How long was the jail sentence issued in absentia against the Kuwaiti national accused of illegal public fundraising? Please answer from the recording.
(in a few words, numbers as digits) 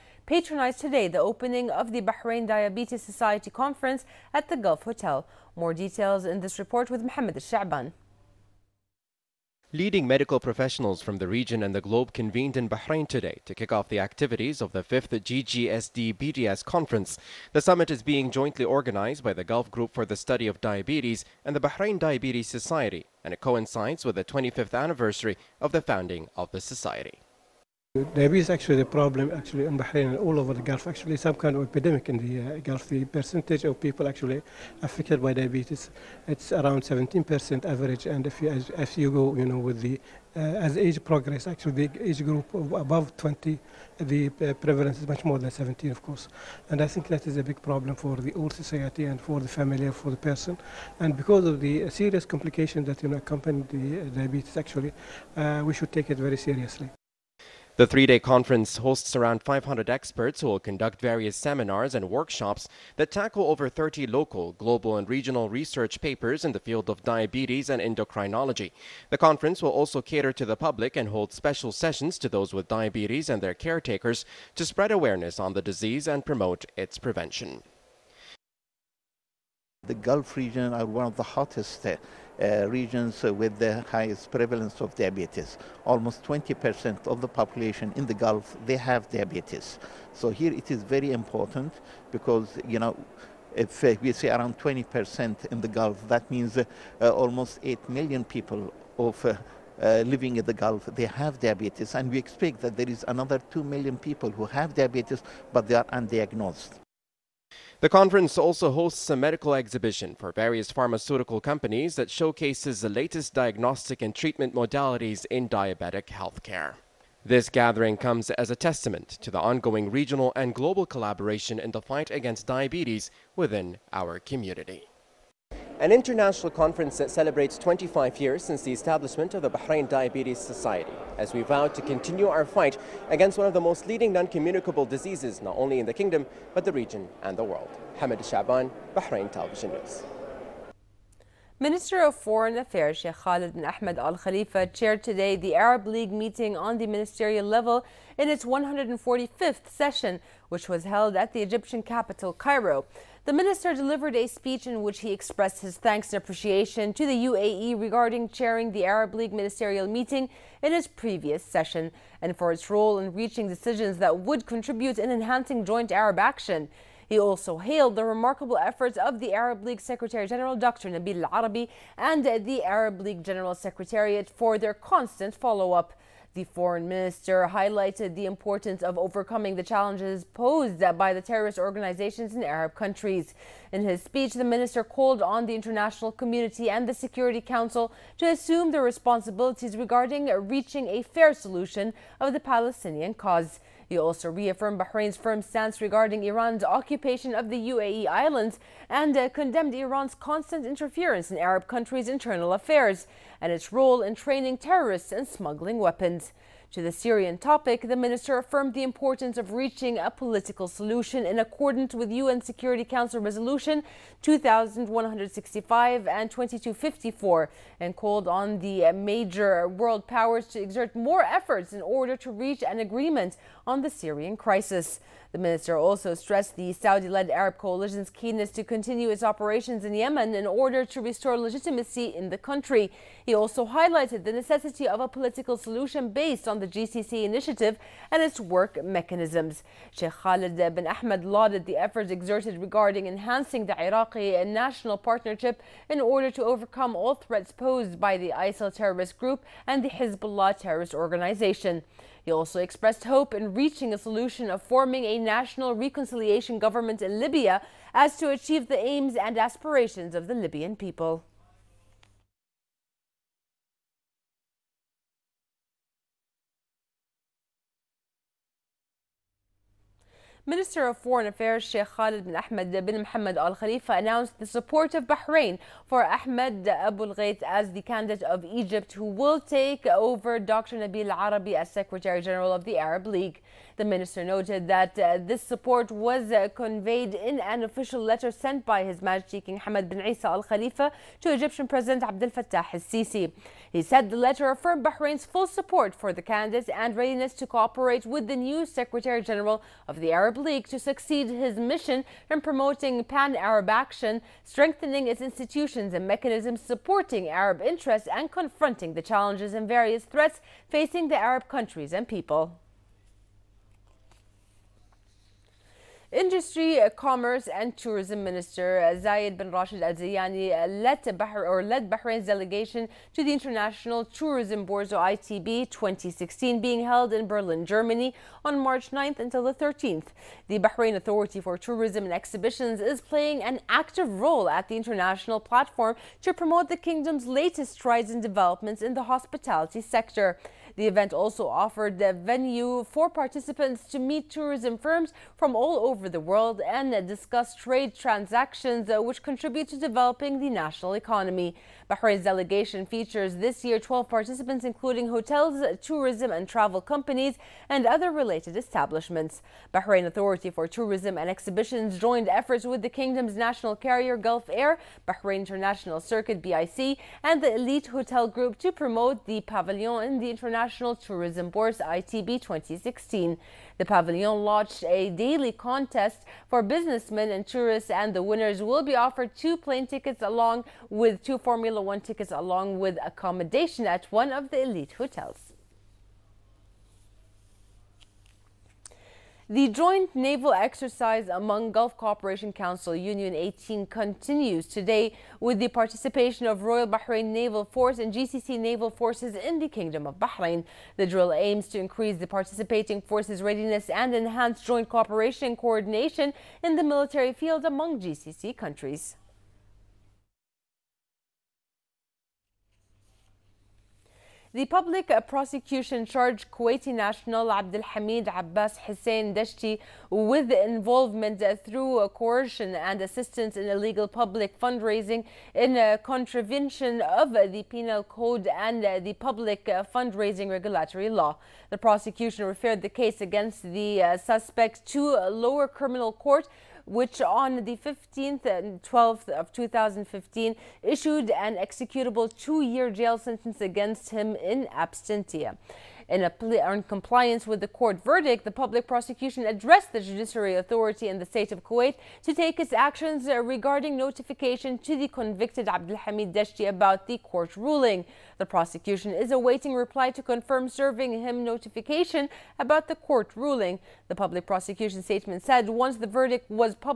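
2 years.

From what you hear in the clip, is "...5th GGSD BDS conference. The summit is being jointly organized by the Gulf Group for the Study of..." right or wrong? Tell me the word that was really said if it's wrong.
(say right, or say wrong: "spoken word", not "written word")
right.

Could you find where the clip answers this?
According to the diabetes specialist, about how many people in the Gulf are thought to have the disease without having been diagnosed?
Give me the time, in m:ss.
1:43.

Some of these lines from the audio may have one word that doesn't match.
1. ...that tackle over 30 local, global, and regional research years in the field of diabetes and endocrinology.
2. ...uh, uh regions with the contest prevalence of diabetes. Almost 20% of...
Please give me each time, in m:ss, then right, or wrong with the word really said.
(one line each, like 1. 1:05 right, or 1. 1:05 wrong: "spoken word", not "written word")
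1. 1:02 wrong: "papers", not "years"
2. 1:21 wrong: "highest", not "contest".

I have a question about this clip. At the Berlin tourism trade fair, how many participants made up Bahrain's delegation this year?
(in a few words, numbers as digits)
12.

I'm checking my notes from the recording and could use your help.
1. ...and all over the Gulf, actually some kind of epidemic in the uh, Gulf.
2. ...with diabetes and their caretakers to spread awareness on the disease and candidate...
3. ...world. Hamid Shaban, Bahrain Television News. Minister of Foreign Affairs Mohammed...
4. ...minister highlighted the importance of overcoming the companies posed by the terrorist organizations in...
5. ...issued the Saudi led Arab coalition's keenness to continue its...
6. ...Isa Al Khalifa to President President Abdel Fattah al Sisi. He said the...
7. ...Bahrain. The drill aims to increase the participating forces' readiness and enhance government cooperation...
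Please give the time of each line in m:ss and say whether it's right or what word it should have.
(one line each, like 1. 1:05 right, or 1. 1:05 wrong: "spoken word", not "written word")
1. 0:30 right
2. 1:12 wrong: "promote", not "candidate"
3. 2:17 wrong: "Sheikh", not "Mohammed"
4. 2:56 wrong: "challenges", not "companies"
5. 3:46 wrong: "stressed", not "issued"
6. 4:49 wrong: "Egyptian", not "President"
7. 6:40 wrong: "joint", not "government".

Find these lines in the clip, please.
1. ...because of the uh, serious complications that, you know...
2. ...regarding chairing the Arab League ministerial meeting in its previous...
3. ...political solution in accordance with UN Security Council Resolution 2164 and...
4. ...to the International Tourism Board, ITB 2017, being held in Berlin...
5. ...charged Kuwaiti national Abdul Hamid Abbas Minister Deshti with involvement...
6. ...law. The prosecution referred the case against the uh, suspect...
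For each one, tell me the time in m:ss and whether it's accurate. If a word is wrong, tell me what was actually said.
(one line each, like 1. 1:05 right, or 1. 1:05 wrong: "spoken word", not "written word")
1. 0:51 right
2. 2:37 right
3. 3:30 wrong: "2165", not "2164"
4. 5:23 wrong: "2016", not "2017"
5. 6:56 wrong: "Hussein", not "Minister"
6. 7:11 right.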